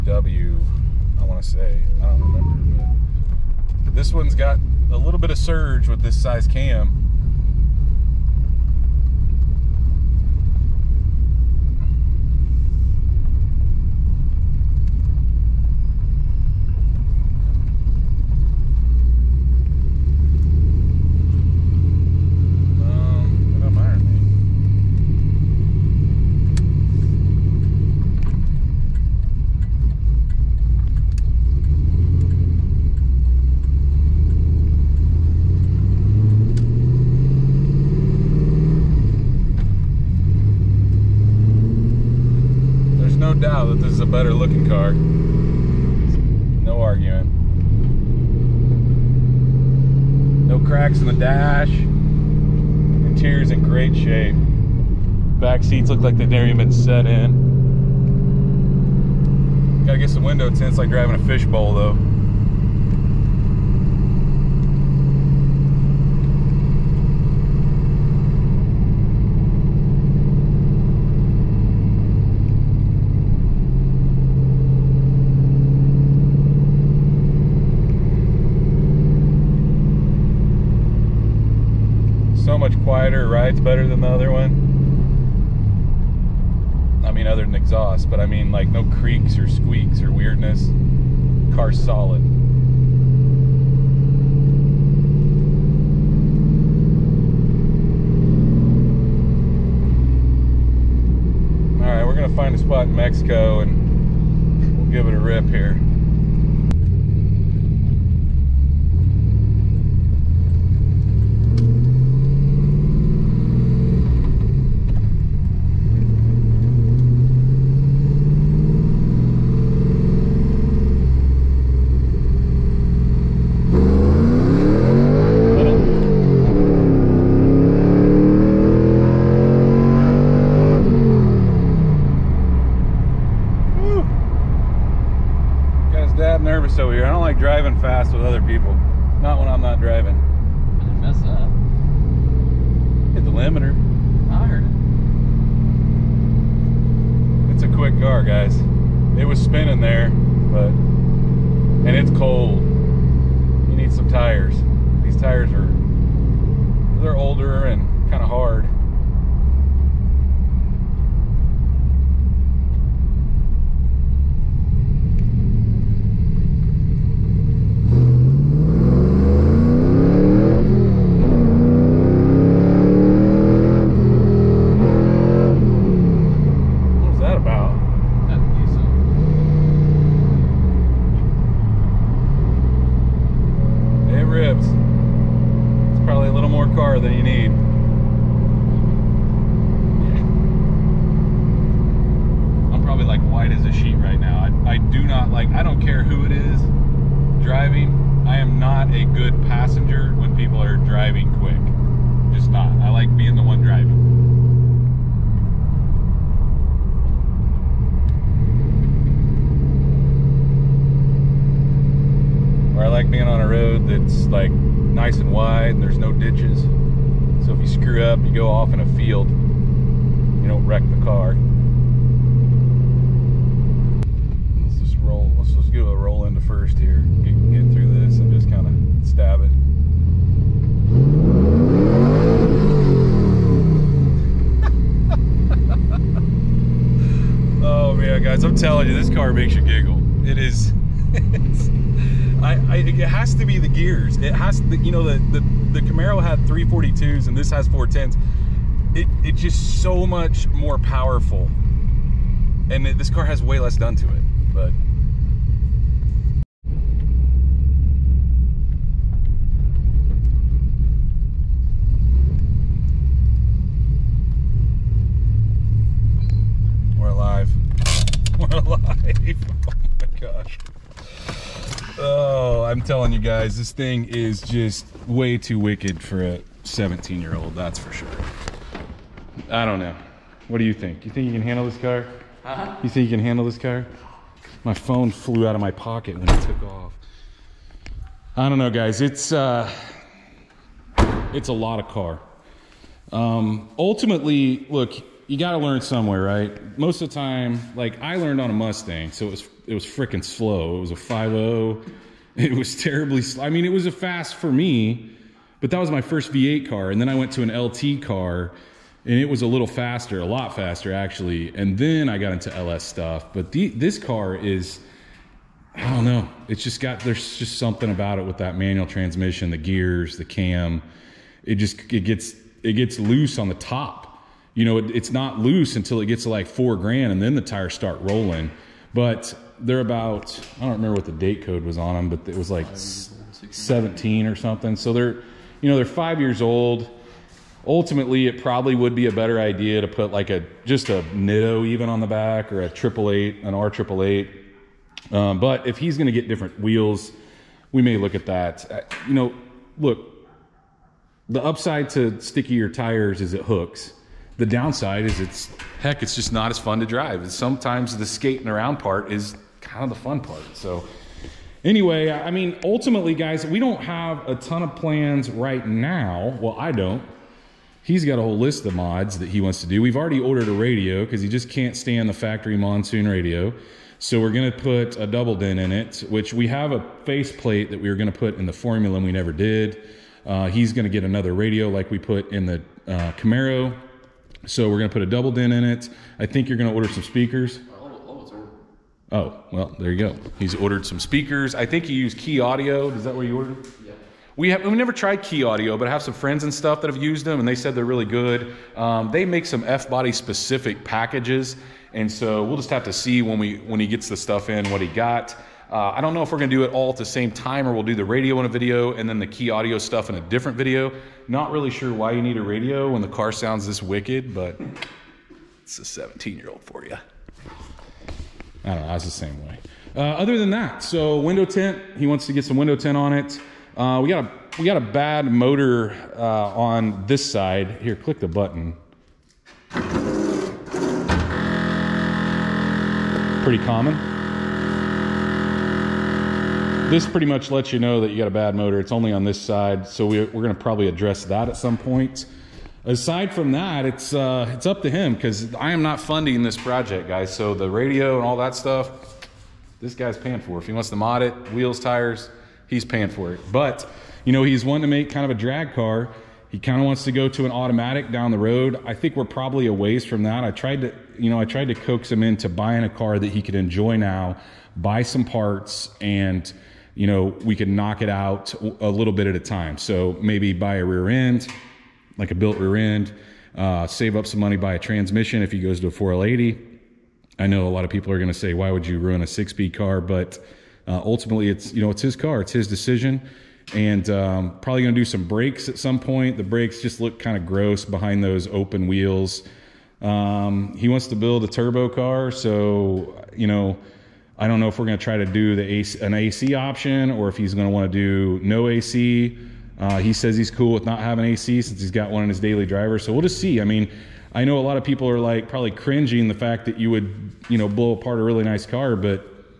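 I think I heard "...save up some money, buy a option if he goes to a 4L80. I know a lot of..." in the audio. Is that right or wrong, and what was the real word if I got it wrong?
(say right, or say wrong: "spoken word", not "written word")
wrong: "transmission", not "option".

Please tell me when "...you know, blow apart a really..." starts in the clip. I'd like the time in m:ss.
8:27.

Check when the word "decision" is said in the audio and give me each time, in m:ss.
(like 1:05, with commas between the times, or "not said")
8:02.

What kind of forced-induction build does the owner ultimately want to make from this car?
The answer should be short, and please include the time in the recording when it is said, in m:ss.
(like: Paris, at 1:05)
turbo car, at 8:11.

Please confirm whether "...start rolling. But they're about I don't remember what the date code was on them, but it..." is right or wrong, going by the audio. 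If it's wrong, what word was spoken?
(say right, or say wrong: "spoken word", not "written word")
right.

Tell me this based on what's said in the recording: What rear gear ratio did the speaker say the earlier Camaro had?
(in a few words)
342s.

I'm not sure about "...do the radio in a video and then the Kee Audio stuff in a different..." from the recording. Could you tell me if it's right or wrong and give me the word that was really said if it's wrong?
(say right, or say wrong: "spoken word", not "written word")
right.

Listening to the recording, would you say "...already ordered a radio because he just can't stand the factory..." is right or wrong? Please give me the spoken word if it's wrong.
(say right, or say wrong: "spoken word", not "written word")
right.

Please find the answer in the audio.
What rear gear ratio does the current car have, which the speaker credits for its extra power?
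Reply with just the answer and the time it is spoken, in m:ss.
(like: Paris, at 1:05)
410s, at 4:07.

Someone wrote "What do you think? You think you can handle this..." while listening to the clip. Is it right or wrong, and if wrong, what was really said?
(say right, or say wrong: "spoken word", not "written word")
right.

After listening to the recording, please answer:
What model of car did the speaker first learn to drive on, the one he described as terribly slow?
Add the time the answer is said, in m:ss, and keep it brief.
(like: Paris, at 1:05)
Mustang, at 4:58.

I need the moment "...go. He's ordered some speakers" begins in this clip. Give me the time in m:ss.
6:29.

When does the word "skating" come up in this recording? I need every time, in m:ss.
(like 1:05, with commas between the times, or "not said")
5:58.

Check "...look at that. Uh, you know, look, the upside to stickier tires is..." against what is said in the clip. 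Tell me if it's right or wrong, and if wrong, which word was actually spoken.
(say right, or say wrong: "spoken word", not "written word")
right.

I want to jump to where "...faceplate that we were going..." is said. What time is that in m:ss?
6:17.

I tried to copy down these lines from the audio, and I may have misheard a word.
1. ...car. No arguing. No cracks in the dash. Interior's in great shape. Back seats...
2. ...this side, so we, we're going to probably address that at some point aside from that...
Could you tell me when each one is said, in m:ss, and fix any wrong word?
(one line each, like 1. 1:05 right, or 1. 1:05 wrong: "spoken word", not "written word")
1. 0:44 right
2. 7:19 right.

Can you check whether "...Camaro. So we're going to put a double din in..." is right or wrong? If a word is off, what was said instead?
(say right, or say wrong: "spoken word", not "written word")
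right.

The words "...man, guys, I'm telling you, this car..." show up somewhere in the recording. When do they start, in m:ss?
3:57.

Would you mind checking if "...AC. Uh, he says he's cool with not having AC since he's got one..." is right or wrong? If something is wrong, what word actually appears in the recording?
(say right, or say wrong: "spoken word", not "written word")
right.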